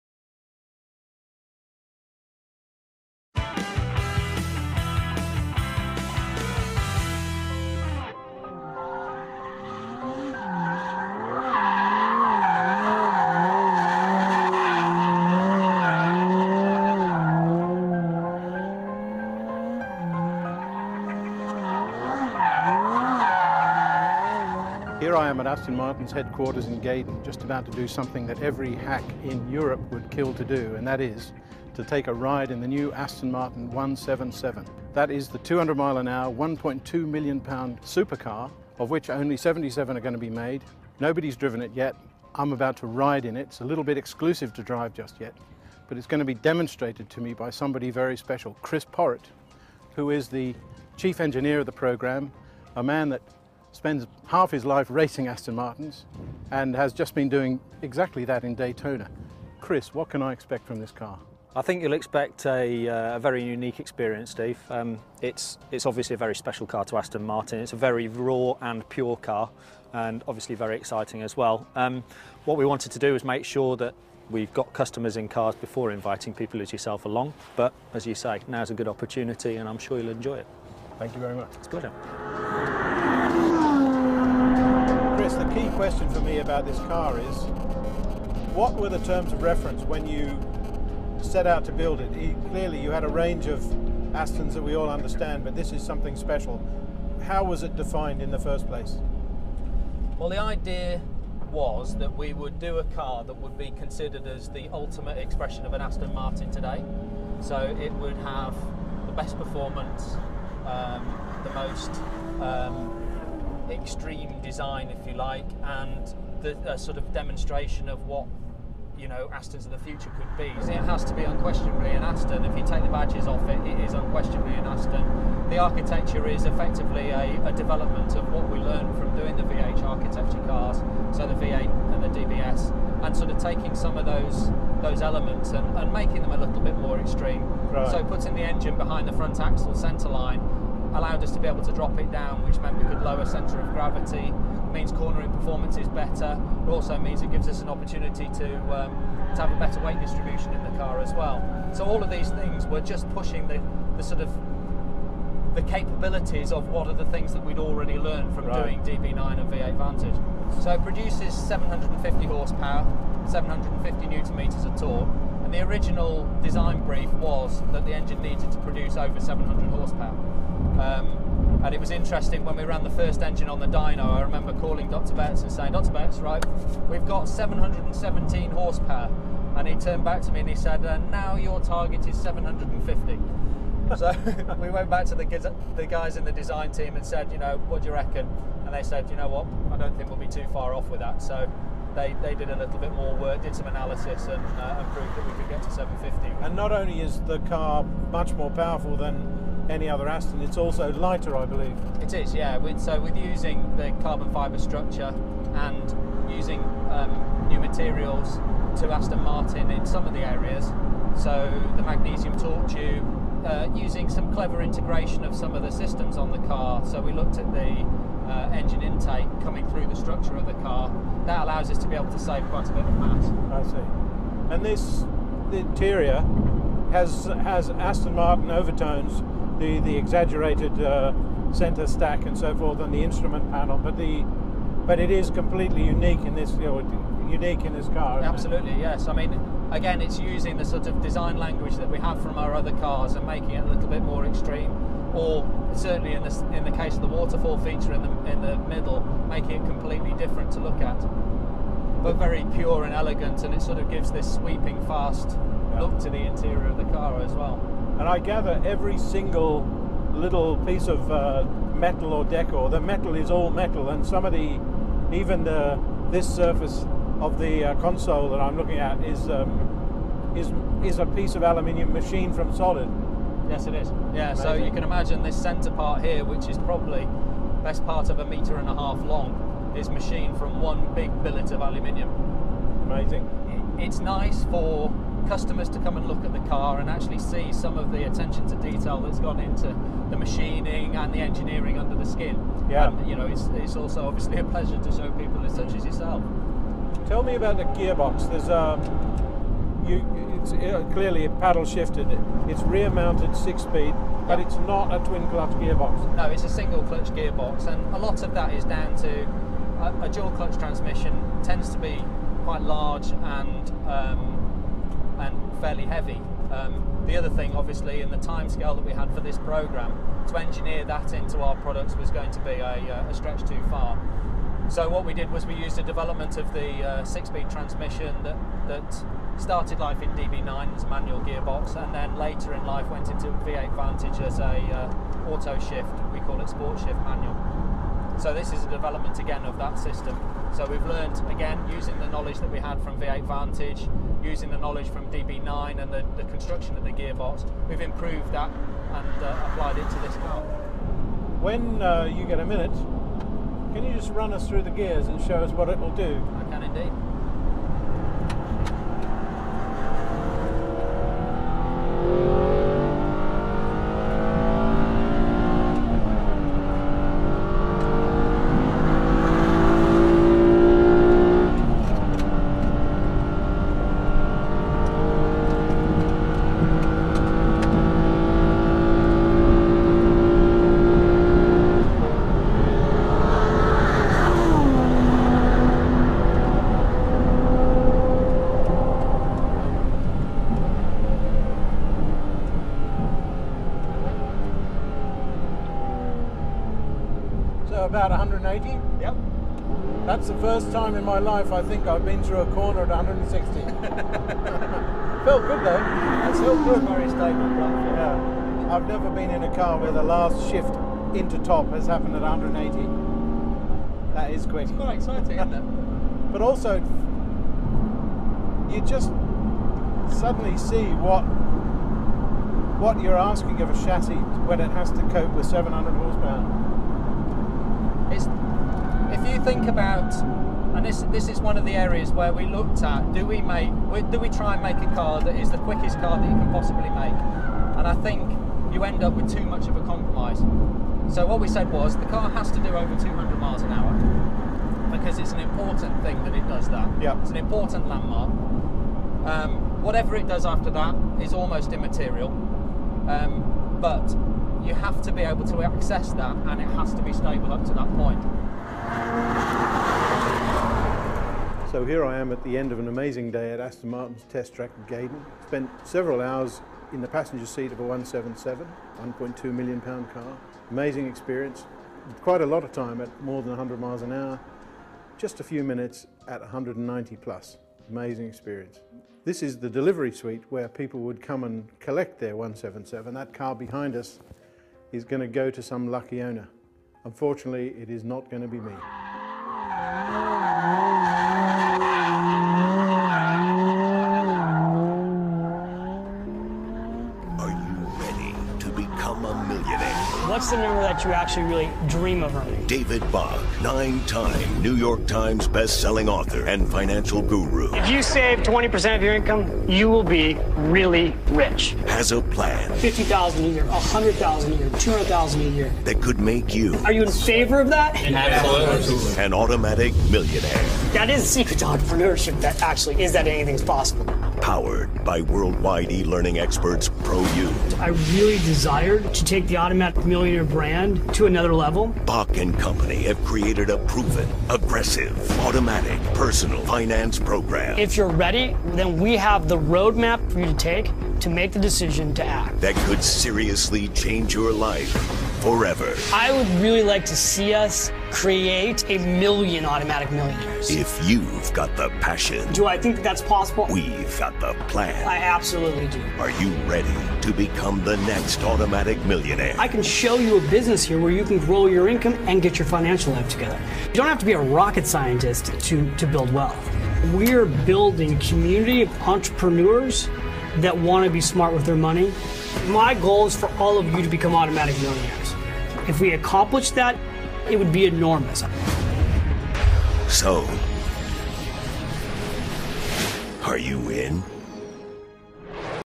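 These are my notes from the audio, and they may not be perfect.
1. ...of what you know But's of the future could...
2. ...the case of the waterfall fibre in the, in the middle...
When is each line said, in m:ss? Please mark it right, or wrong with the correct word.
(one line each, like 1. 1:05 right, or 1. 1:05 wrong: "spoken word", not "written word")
1. 1:57 wrong: "Aston", not "But"
2. 4:06 wrong: "feature", not "fibre".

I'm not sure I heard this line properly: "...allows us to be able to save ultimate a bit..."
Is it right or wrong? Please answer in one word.
wrong.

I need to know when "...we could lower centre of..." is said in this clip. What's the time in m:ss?
2:22.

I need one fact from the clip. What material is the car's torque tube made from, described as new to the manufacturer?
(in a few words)
Magnesium.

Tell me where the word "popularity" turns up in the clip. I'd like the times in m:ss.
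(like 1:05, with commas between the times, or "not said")
not said.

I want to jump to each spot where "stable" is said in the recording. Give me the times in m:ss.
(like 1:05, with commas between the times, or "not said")
6:47, 7:37.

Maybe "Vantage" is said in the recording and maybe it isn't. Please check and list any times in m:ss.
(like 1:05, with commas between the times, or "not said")
2:39, 5:33, 5:43.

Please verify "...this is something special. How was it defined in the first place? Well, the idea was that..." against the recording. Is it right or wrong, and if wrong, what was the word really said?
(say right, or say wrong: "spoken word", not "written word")
right.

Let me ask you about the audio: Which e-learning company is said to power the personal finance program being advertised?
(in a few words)
ProU.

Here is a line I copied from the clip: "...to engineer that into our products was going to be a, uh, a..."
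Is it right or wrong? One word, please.
right.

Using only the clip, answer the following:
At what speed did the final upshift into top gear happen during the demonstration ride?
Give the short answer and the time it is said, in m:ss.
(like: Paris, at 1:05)
180, at 6:52.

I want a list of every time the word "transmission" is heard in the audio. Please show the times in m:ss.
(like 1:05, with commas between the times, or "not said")
5:10, 5:27.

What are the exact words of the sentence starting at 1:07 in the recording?
It's a very raw and pure car and obviously very exciting as well.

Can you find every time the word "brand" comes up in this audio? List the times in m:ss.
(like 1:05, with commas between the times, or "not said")
8:50.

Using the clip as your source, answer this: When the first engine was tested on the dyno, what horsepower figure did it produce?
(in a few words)
717 horsepower.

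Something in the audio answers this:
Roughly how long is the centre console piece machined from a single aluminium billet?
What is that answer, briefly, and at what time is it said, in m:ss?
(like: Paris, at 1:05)
1.5 metres, at 4:38.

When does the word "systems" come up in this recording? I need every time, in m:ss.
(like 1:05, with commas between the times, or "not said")
3:35, 5:39.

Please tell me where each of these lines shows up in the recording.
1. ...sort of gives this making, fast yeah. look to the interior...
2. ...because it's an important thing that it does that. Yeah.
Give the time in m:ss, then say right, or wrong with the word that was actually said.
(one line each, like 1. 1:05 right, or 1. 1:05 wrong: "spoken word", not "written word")
1. 4:13 wrong: "sweeping", not "making"
2. 7:24 right.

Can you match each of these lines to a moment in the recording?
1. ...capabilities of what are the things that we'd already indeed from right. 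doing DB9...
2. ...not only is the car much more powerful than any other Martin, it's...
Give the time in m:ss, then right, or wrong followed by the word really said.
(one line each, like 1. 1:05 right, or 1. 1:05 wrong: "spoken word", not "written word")
1. 2:35 wrong: "learned", not "indeed"
2. 3:16 wrong: "Aston", not "Martin".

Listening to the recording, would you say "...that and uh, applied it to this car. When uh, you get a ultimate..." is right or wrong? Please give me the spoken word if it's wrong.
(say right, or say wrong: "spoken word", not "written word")
wrong: "minute", not "ultimate".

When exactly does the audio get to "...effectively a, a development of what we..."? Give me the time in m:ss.
2:06.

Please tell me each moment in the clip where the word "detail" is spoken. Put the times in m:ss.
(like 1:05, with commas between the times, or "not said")
4:48.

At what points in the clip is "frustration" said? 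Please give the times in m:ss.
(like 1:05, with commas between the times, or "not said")
not said.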